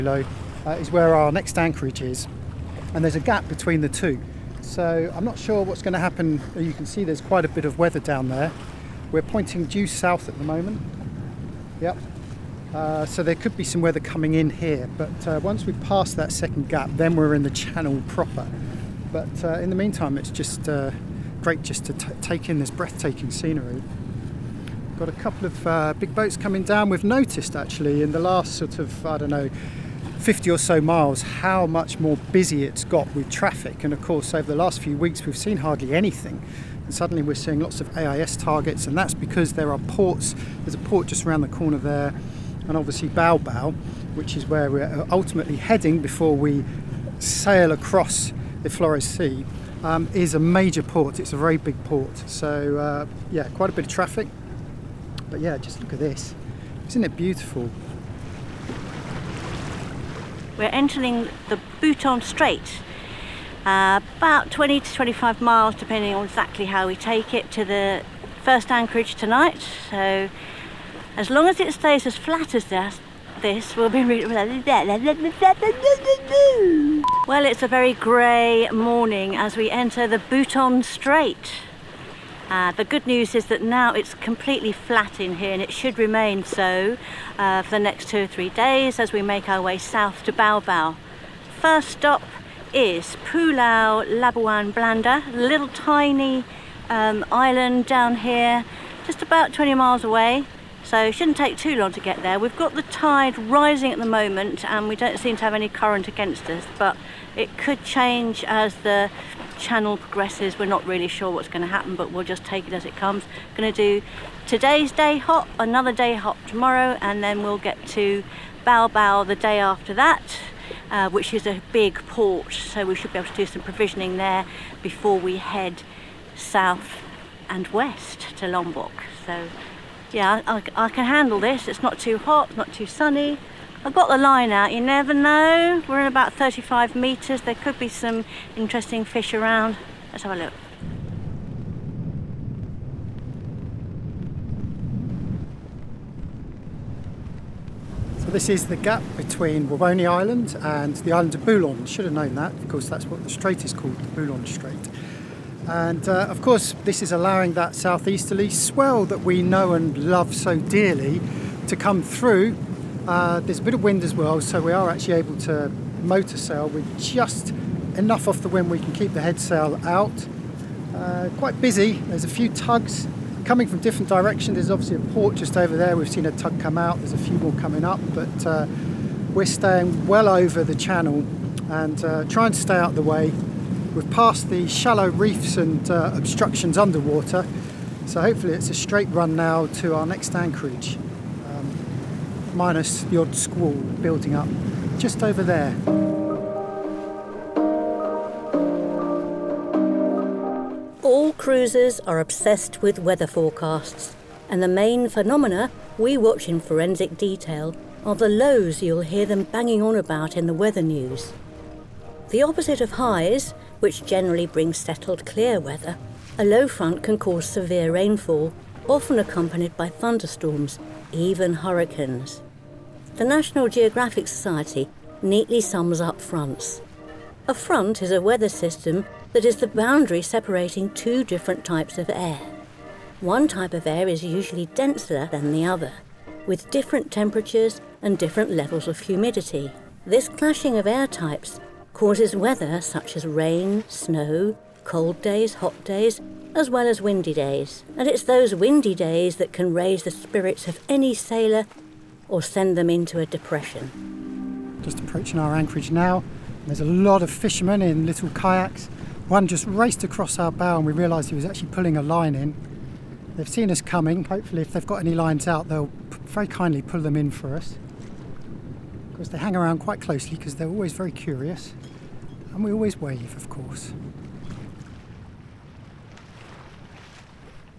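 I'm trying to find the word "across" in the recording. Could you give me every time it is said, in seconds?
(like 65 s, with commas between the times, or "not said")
47 s, 260 s.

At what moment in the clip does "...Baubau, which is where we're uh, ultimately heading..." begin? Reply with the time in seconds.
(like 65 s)
43 s.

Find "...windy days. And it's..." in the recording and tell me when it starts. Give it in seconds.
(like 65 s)
247 s.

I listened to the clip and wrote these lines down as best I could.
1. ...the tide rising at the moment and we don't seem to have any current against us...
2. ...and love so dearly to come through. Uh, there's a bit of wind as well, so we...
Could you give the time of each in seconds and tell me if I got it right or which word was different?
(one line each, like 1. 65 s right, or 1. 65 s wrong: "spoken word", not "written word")
1. 102 s right
2. 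159 s right.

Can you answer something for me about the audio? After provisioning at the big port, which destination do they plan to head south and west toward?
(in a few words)
Lombok.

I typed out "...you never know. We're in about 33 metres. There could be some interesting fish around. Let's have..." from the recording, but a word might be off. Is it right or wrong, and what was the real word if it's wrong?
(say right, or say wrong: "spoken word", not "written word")
wrong: "35", not "33".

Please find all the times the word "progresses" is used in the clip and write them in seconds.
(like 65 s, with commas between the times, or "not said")
109 s.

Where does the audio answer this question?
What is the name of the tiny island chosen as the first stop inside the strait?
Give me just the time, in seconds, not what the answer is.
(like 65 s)
93 s.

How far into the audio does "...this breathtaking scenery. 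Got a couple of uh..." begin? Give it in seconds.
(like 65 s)
22 s.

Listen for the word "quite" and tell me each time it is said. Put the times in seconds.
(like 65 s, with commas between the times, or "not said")
7 s, 53 s, 171 s, 269 s.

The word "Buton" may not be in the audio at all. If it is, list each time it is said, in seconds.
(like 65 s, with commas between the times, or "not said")
61 s, 80 s.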